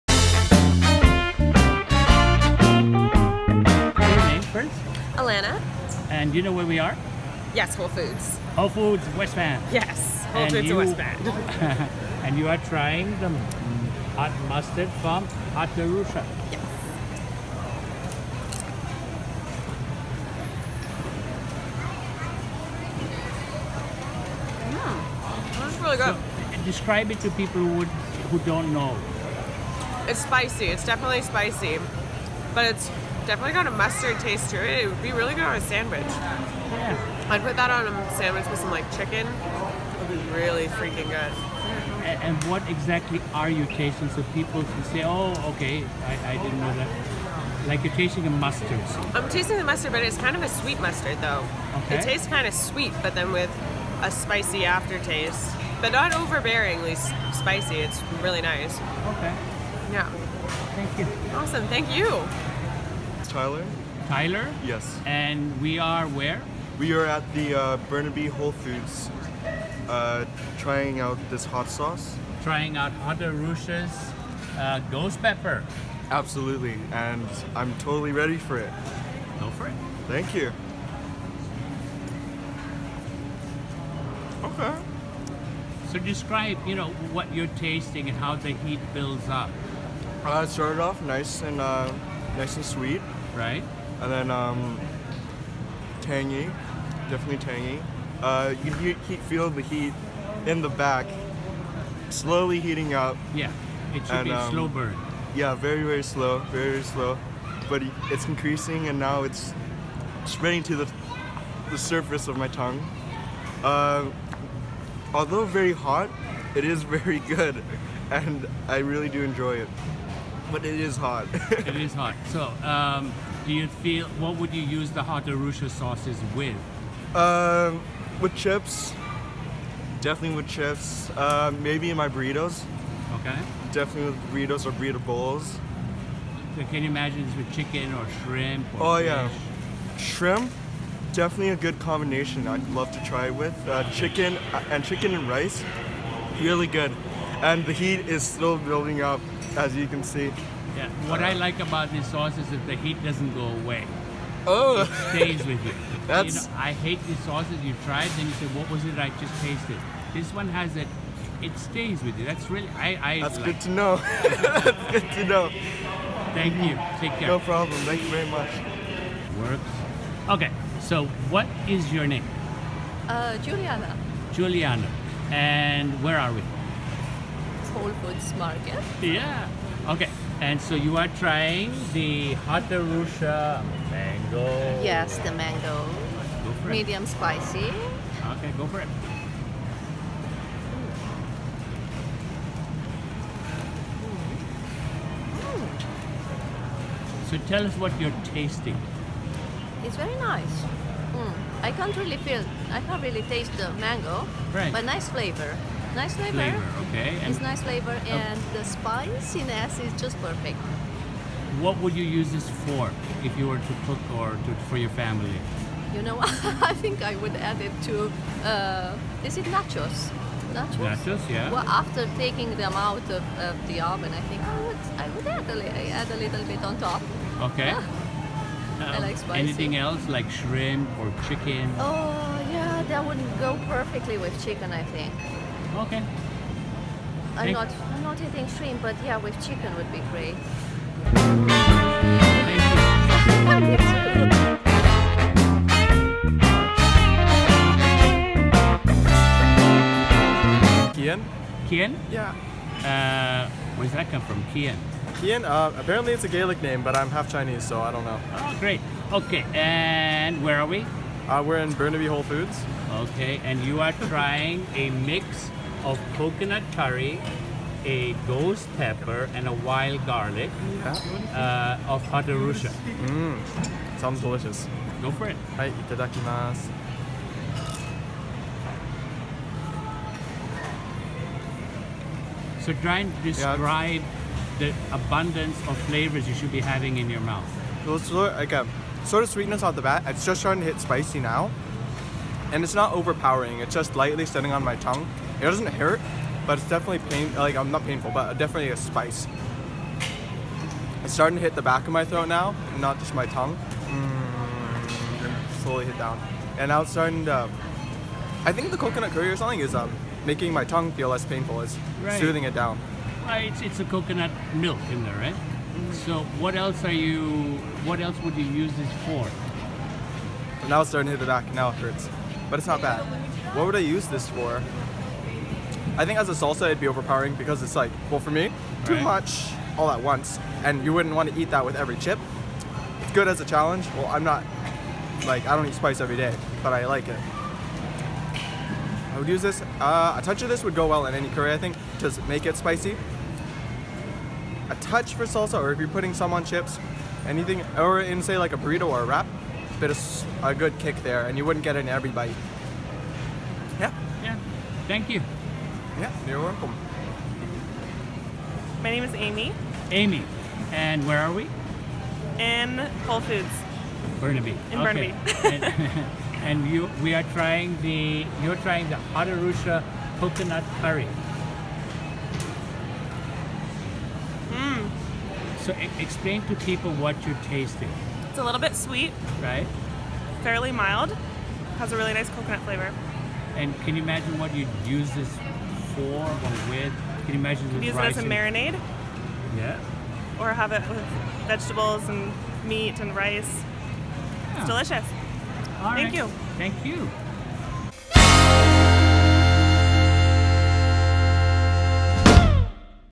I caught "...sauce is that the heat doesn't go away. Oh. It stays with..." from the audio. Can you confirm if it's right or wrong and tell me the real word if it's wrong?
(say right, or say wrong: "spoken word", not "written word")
right.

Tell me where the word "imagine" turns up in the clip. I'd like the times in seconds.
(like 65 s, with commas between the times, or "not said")
136 s, 384 s.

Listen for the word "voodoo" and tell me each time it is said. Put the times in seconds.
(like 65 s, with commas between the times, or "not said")
not said.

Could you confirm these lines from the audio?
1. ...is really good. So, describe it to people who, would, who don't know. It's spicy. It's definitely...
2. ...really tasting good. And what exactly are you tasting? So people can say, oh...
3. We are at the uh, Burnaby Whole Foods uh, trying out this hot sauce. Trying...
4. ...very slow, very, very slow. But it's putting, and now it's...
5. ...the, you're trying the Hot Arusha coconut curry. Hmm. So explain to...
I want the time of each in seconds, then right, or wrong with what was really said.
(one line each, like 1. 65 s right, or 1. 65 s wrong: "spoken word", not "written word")
1. 25 s right
2. 40 s wrong: "freaking", not "tasting"
3. 66 s right
4. 105 s wrong: "increasing", not "putting"
5. 367 s right.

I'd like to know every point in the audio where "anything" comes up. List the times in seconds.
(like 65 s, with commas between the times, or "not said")
229 s, 347 s.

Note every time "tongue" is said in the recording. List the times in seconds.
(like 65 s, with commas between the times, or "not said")
112 s, 294 s, 303 s, 310 s.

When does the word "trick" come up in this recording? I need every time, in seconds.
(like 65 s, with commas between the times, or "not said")
not said.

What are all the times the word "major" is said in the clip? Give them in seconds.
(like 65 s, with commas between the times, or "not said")
not said.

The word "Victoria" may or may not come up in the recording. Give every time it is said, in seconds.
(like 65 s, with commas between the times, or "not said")
not said.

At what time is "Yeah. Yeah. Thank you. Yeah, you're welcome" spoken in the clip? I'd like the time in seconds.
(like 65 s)
353 s.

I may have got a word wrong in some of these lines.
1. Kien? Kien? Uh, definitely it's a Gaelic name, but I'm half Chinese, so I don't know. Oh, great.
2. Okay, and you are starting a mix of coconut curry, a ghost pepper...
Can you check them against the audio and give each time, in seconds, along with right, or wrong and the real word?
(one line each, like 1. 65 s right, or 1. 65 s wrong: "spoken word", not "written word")
1. 254 s wrong: "apparently", not "definitely"
2. 262 s wrong: "trying", not "starting".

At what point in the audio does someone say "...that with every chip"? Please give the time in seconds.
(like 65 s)
331 s.